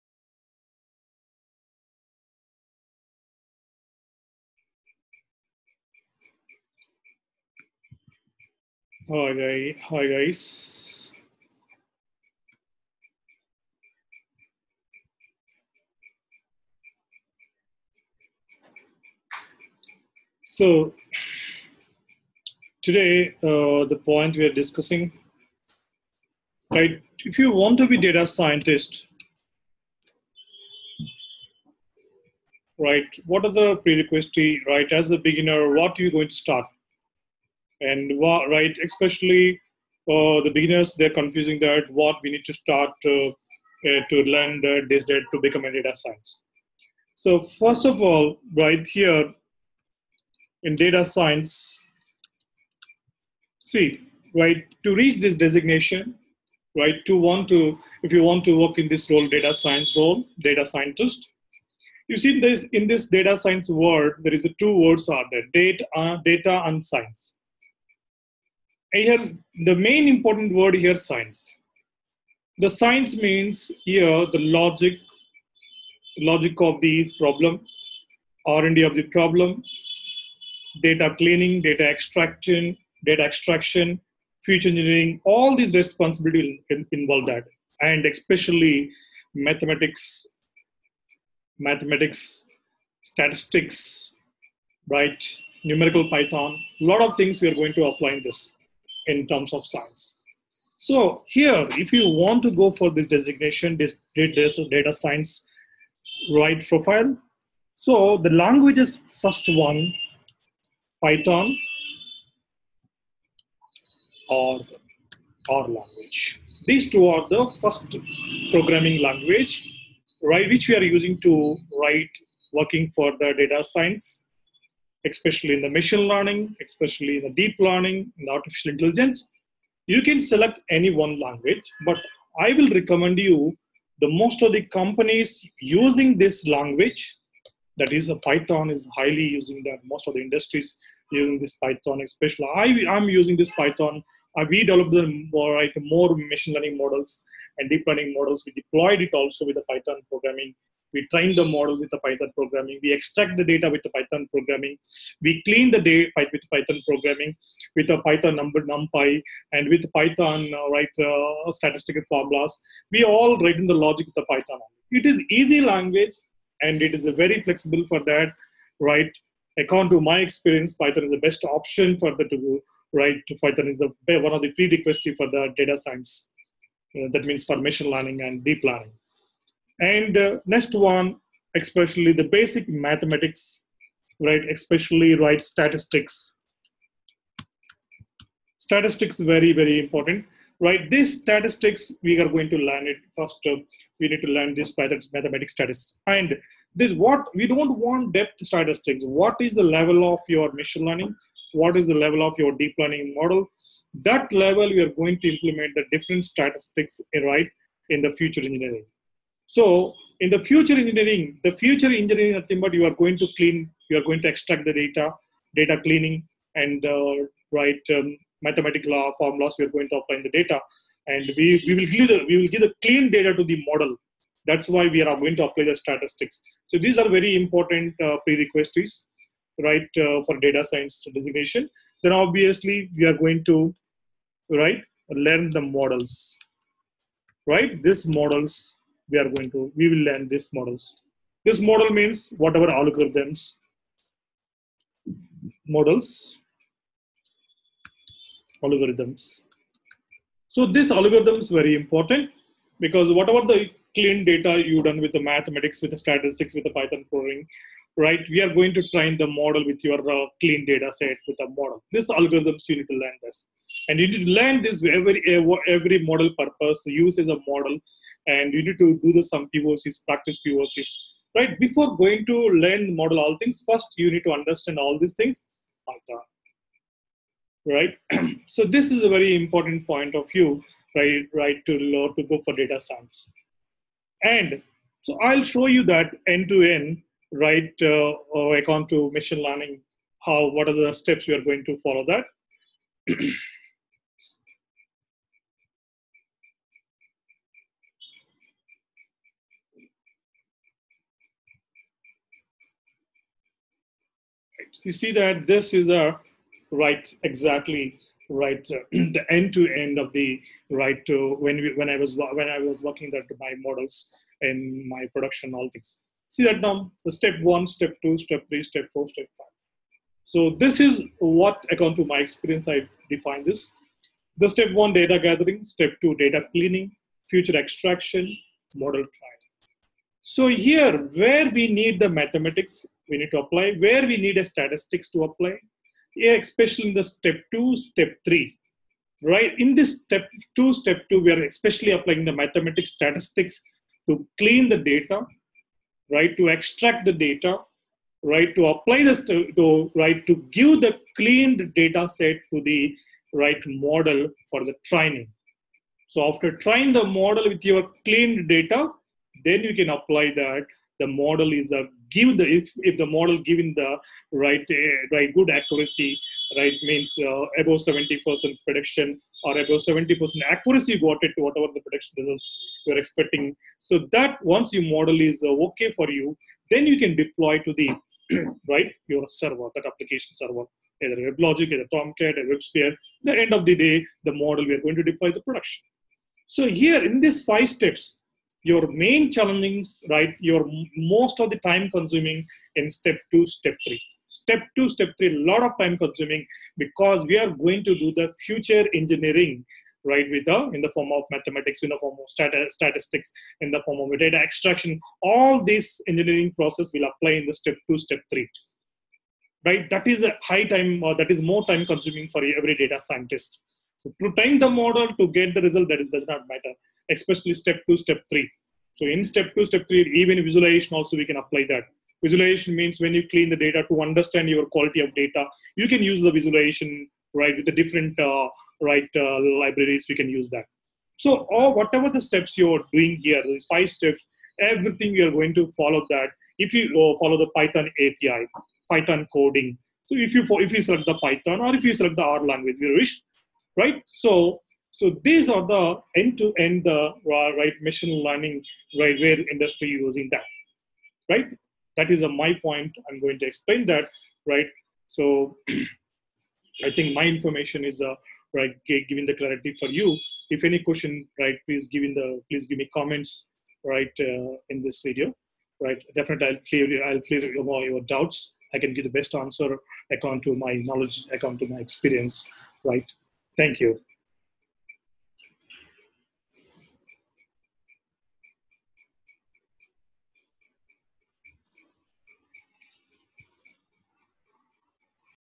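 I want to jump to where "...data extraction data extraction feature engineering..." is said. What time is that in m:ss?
1:21.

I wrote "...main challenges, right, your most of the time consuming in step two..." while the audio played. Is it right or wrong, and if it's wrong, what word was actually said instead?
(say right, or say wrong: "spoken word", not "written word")
right.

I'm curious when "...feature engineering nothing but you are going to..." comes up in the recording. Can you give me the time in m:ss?
3:31.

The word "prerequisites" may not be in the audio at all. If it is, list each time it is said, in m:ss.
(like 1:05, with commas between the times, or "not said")
0:33, 2:54, 3:48.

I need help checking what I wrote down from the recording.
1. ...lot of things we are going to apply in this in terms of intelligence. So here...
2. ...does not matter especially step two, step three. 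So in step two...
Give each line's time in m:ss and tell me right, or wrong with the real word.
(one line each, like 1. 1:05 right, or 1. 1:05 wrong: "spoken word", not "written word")
1. 1:36 wrong: "science", not "intelligence"
2. 6:56 right.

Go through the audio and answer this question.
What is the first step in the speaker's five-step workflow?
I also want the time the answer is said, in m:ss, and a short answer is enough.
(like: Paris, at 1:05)
Data gathering, at 5:24.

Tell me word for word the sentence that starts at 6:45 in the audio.
All this engineering process will apply in the step two, step three.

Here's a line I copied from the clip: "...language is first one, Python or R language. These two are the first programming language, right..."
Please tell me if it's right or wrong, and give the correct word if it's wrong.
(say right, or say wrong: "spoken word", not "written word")
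right.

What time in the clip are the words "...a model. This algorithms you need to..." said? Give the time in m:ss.
4:21.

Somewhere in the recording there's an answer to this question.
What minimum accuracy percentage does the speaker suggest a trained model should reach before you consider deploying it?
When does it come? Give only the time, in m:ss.
6:09.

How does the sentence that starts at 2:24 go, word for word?
Uh, we developed the like, more machine learning models and deep learning models.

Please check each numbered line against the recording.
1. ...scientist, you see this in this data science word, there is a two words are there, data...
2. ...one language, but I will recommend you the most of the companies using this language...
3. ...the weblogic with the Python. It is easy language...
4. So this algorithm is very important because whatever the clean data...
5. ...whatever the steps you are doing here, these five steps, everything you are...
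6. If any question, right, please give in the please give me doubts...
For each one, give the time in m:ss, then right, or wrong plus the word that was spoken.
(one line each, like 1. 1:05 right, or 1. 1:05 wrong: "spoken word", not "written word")
1. 1:00 right
2. 2:10 right
3. 2:43 wrong: "logic", not "weblogic"
4. 4:10 right
5. 7:11 right
6. 7:40 wrong: "comments", not "doubts".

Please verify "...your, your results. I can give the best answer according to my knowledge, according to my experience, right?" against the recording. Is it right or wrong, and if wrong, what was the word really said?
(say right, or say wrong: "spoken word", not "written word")
wrong: "doubts", not "results".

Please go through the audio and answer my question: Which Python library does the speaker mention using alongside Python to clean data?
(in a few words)
NumPy.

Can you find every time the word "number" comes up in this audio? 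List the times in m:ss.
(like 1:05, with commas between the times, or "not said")
2:38.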